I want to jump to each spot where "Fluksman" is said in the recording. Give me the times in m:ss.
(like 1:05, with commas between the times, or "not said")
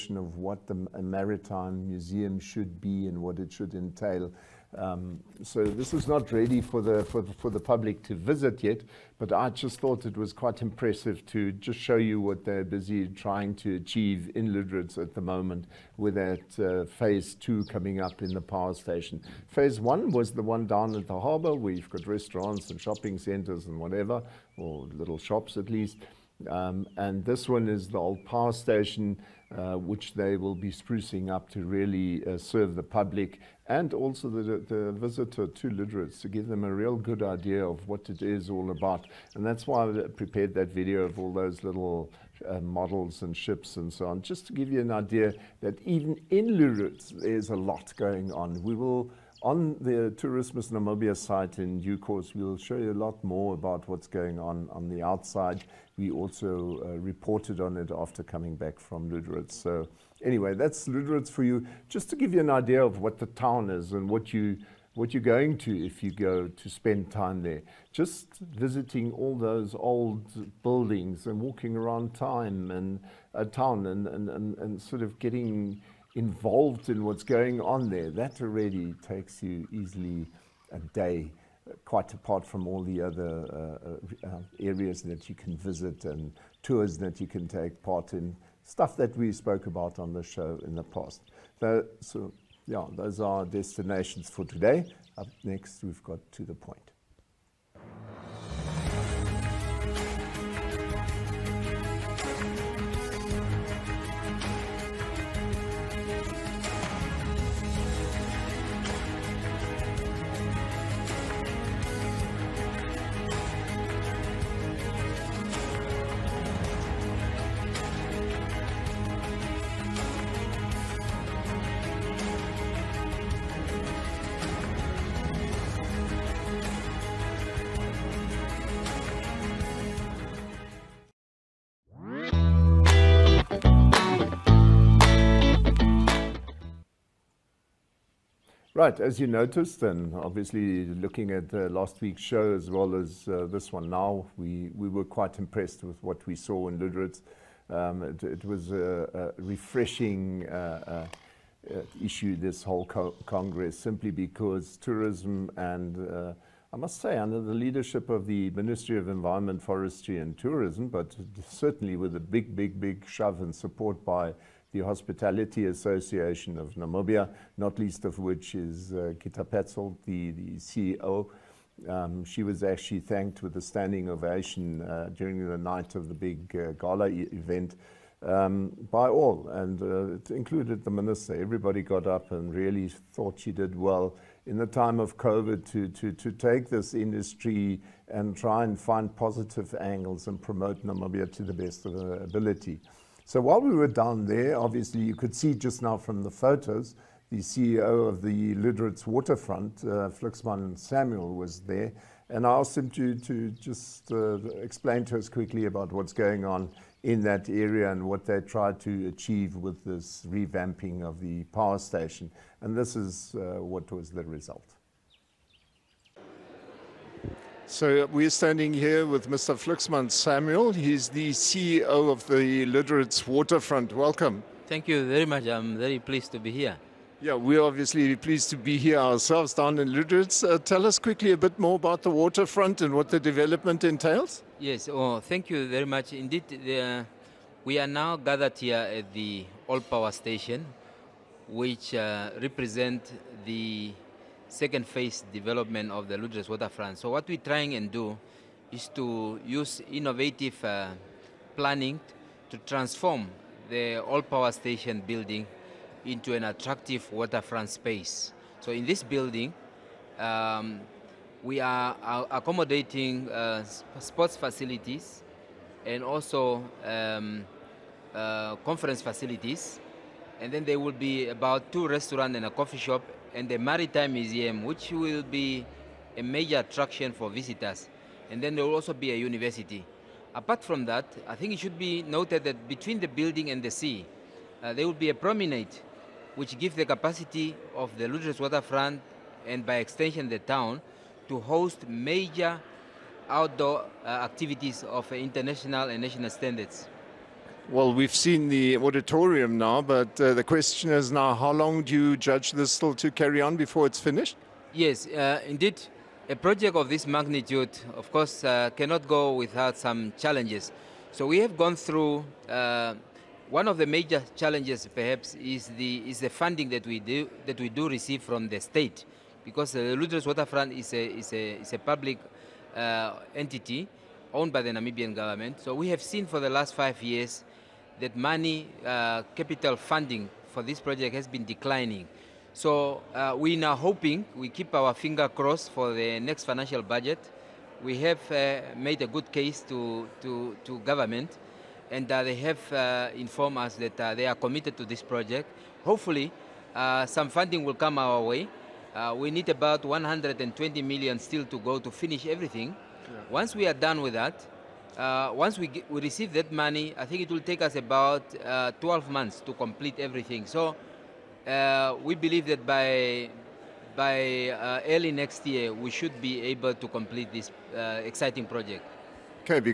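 3:20, 3:39.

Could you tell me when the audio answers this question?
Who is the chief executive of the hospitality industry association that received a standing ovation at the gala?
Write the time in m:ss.
2:49.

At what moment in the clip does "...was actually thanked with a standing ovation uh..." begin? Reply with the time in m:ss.
2:52.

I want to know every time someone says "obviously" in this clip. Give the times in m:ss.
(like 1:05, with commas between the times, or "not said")
2:20, 3:14, 3:47.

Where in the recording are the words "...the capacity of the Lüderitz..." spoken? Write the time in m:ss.
4:46.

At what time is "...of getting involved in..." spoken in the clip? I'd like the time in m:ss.
1:15.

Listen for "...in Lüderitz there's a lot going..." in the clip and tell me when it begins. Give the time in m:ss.
0:46.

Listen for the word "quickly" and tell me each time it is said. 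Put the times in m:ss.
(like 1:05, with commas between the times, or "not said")
3:25, 3:50.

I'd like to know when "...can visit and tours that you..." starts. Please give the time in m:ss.
1:25.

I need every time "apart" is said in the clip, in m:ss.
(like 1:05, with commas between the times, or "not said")
1:22, 4:40.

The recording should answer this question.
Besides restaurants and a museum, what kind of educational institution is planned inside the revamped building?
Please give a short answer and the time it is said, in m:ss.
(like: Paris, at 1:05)
A university, at 4:39.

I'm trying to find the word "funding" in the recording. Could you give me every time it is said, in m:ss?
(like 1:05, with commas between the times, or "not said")
5:16, 5:29, 5:47.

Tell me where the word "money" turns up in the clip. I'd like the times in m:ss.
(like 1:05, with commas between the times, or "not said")
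5:28, 5:56.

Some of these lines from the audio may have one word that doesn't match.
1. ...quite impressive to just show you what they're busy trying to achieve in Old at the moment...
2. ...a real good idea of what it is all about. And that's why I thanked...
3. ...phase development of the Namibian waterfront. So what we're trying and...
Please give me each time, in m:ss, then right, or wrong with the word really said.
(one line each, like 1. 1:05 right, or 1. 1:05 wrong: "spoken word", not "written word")
1. 0:10 wrong: "Lüderitz", not "Old"
2. 0:36 wrong: "prepared", not "thanked"
3. 4:04 wrong: "Lüderitz", not "Namibian".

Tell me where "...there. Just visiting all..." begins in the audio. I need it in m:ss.
1:07.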